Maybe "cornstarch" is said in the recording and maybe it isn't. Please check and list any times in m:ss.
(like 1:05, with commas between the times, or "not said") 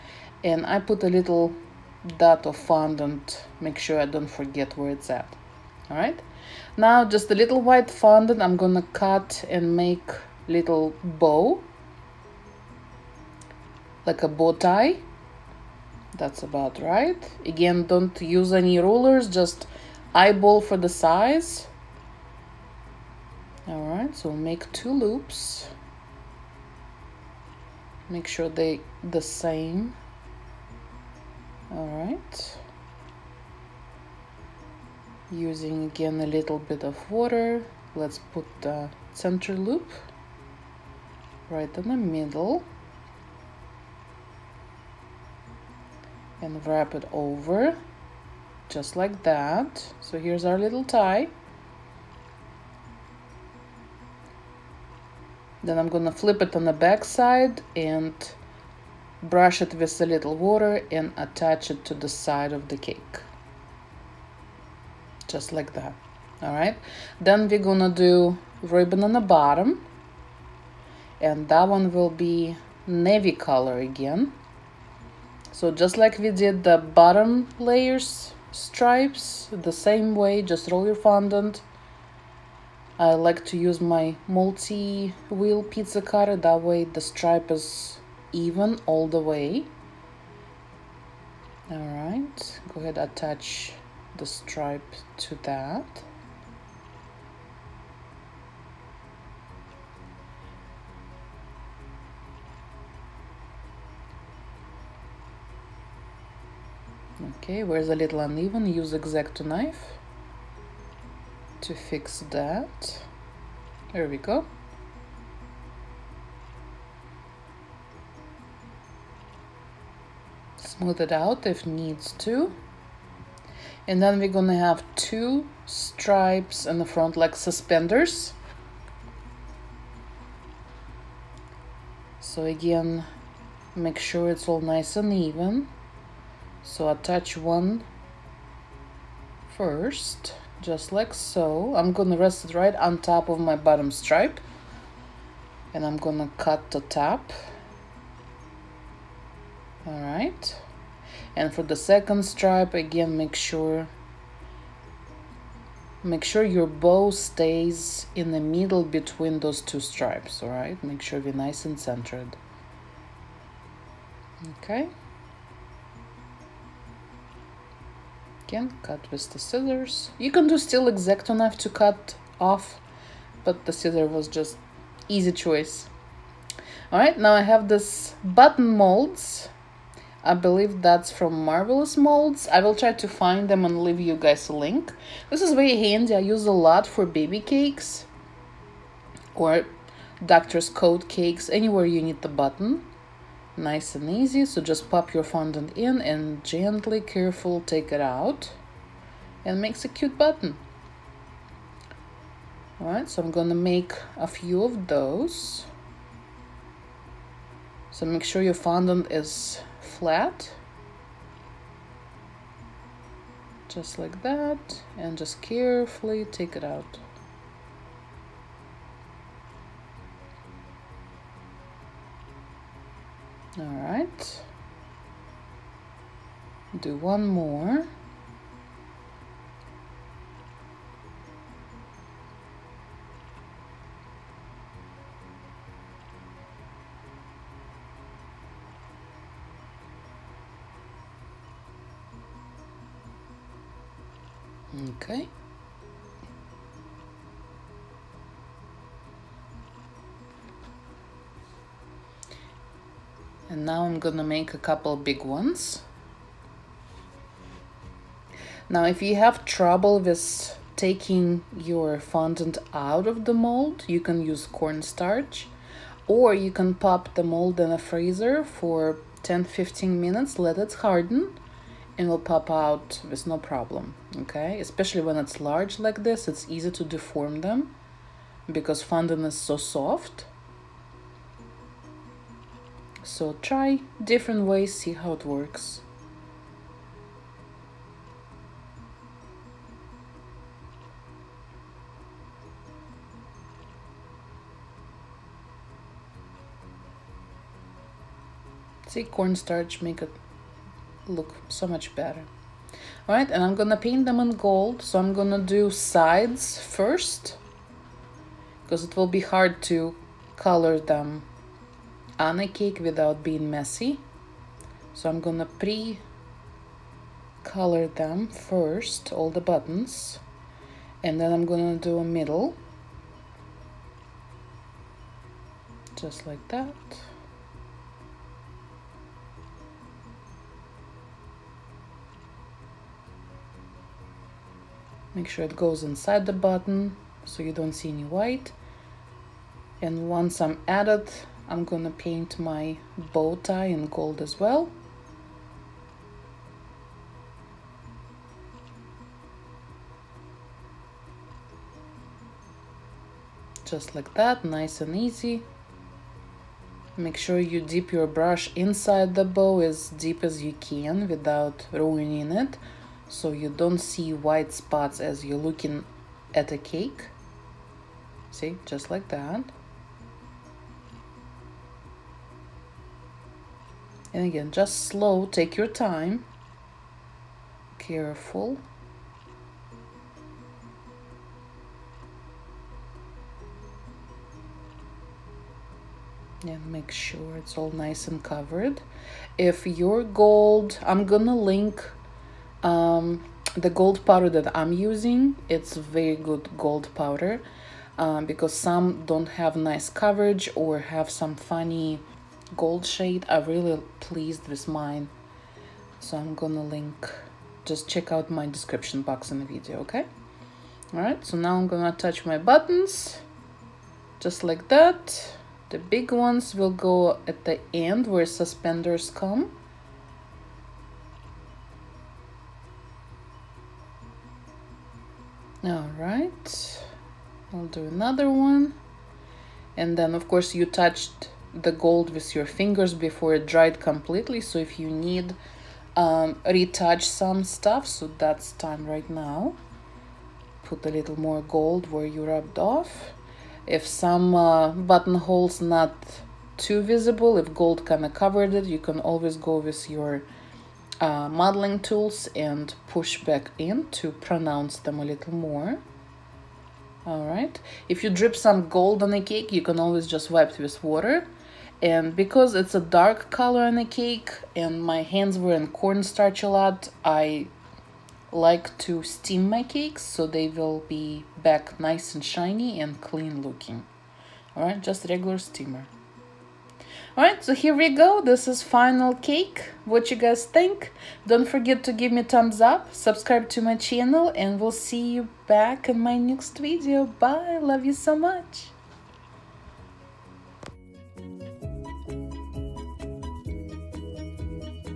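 4:24, 4:59, 7:45.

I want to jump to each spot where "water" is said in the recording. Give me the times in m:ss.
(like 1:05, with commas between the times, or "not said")
0:37, 1:00, 7:40.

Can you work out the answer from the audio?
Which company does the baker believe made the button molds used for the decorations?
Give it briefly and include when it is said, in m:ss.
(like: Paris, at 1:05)
Marvelous Molds, at 3:01.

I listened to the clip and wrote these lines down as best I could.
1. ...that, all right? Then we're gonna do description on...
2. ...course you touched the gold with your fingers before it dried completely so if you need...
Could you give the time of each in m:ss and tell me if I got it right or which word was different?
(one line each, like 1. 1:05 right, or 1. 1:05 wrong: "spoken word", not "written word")
1. 1:05 wrong: "ribbon", not "description"
2. 7:10 right.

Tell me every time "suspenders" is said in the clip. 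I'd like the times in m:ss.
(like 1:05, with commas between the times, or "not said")
2:07, 6:58.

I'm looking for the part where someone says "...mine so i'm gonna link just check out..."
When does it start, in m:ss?
6:44.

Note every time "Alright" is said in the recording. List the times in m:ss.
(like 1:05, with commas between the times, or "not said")
1:31, 2:56.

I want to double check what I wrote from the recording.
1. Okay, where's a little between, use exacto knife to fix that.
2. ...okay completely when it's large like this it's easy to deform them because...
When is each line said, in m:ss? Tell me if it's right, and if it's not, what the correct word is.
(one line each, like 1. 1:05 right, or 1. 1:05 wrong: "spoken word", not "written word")
1. 1:47 wrong: "uneven", not "between"
2. 4:34 wrong: "especially", not "completely".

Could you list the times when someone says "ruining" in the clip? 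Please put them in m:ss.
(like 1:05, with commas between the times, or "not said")
6:01.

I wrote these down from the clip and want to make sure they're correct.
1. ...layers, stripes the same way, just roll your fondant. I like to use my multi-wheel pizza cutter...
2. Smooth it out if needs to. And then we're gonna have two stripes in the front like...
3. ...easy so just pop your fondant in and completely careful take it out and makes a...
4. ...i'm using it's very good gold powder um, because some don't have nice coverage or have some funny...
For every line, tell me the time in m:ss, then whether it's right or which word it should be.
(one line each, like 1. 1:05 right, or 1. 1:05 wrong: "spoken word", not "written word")
1. 1:17 right
2. 2:00 right
3. 3:14 wrong: "gently", not "completely"
4. 6:34 right.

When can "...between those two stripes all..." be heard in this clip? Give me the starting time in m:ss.
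2:38.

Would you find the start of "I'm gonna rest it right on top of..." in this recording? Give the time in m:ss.
2:21.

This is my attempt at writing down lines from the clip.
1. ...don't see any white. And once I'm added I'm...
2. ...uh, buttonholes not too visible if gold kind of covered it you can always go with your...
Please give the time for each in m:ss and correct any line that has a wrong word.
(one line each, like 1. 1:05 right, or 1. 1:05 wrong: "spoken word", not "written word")
1. 5:37 right
2. 7:24 right.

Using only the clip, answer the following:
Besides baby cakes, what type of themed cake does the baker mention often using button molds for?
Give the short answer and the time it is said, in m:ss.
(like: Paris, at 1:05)
doctor's coat cakes, at 3:10.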